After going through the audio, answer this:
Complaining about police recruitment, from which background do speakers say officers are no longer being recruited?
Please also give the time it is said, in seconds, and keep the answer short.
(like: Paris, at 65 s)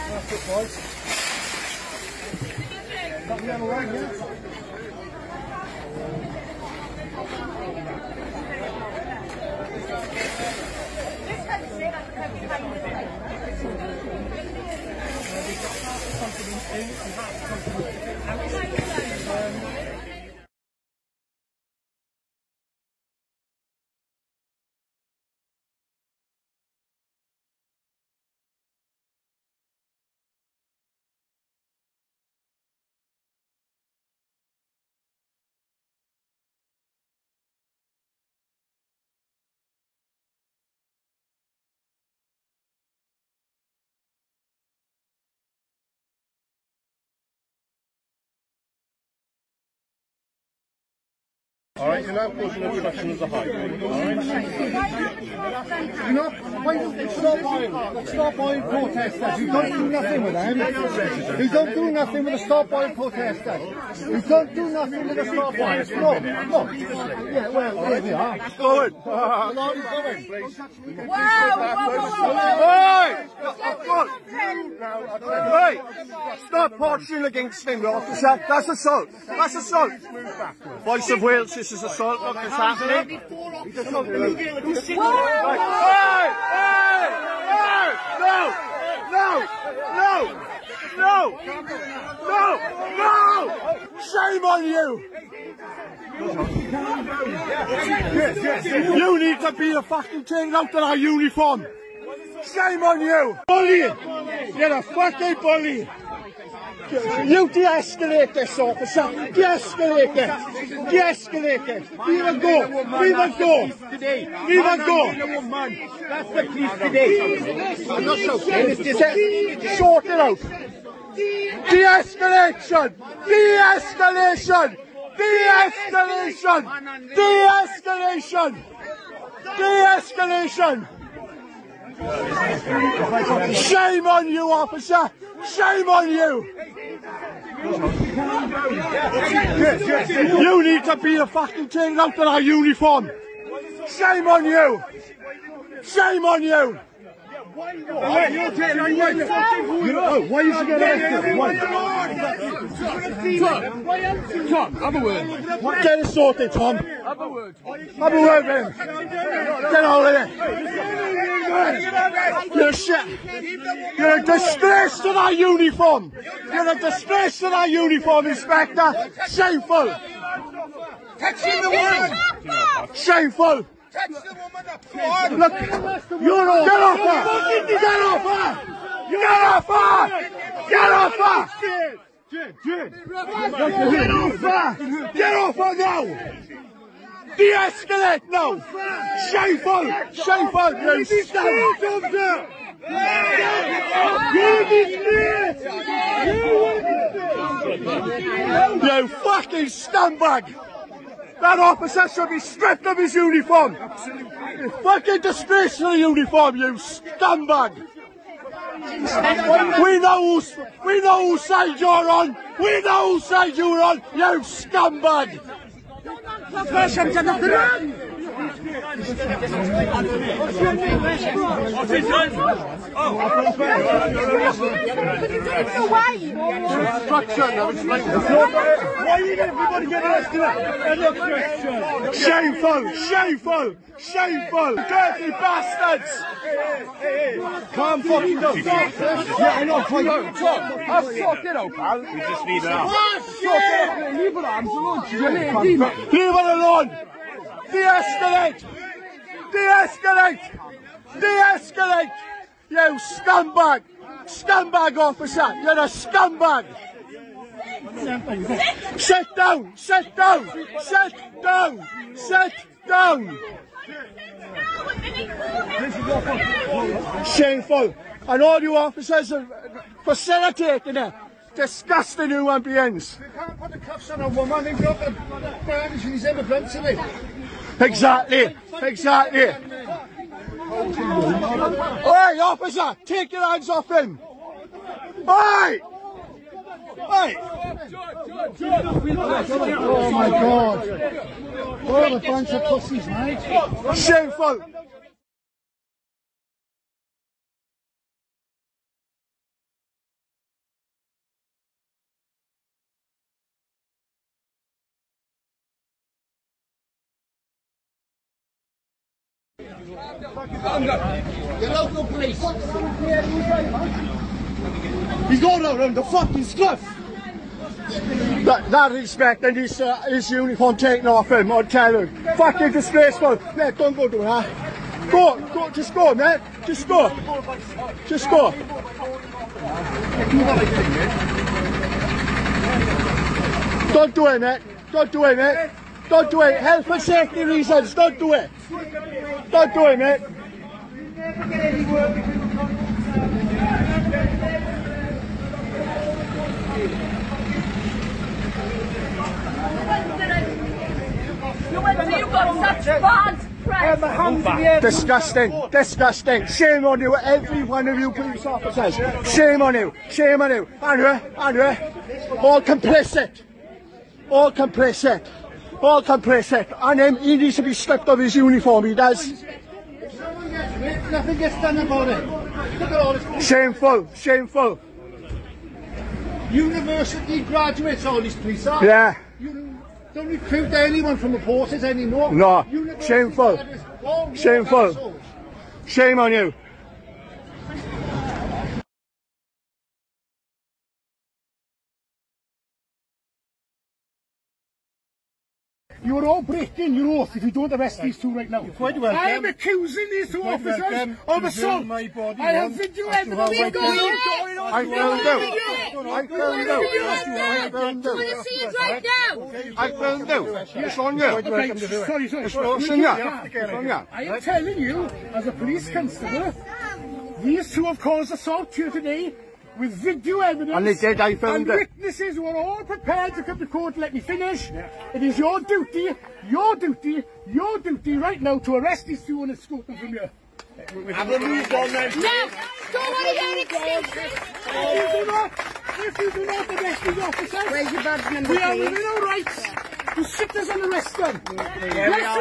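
the forces, at 381 s.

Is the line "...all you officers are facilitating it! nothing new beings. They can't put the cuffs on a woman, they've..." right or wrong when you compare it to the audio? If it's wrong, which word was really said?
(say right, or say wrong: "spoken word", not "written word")
wrong: "disgusting", not "nothing".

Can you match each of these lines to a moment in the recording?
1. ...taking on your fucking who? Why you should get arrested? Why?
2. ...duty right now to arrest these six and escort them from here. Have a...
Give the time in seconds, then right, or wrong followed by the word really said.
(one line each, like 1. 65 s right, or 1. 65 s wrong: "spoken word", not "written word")
1. 148 s right
2. 427 s wrong: "two", not "six".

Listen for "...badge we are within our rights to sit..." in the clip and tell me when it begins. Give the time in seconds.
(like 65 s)
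438 s.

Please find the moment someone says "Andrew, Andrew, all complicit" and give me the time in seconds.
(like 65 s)
360 s.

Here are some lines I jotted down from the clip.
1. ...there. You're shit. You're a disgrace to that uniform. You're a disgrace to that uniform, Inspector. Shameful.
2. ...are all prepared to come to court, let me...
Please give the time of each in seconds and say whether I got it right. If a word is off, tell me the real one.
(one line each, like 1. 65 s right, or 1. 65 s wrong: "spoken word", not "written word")
1. 160 s right
2. 422 s right.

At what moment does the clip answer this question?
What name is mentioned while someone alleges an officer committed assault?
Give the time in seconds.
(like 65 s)
80 s.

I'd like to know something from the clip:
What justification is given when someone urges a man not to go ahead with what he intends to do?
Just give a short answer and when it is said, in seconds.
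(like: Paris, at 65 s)
Health and safety reasons, at 336 s.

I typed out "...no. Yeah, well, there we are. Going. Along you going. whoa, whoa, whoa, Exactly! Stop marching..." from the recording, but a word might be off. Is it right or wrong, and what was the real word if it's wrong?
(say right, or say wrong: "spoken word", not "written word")
wrong: "Hey", not "Exactly".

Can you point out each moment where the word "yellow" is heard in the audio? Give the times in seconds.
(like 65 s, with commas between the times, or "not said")
3 s.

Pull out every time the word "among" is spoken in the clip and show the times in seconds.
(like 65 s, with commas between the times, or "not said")
not said.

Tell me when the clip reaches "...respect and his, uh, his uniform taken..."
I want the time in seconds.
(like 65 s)
318 s.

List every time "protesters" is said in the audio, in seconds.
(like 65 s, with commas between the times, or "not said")
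58 s, 62 s.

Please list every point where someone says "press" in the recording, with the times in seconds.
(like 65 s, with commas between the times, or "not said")
353 s, 366 s.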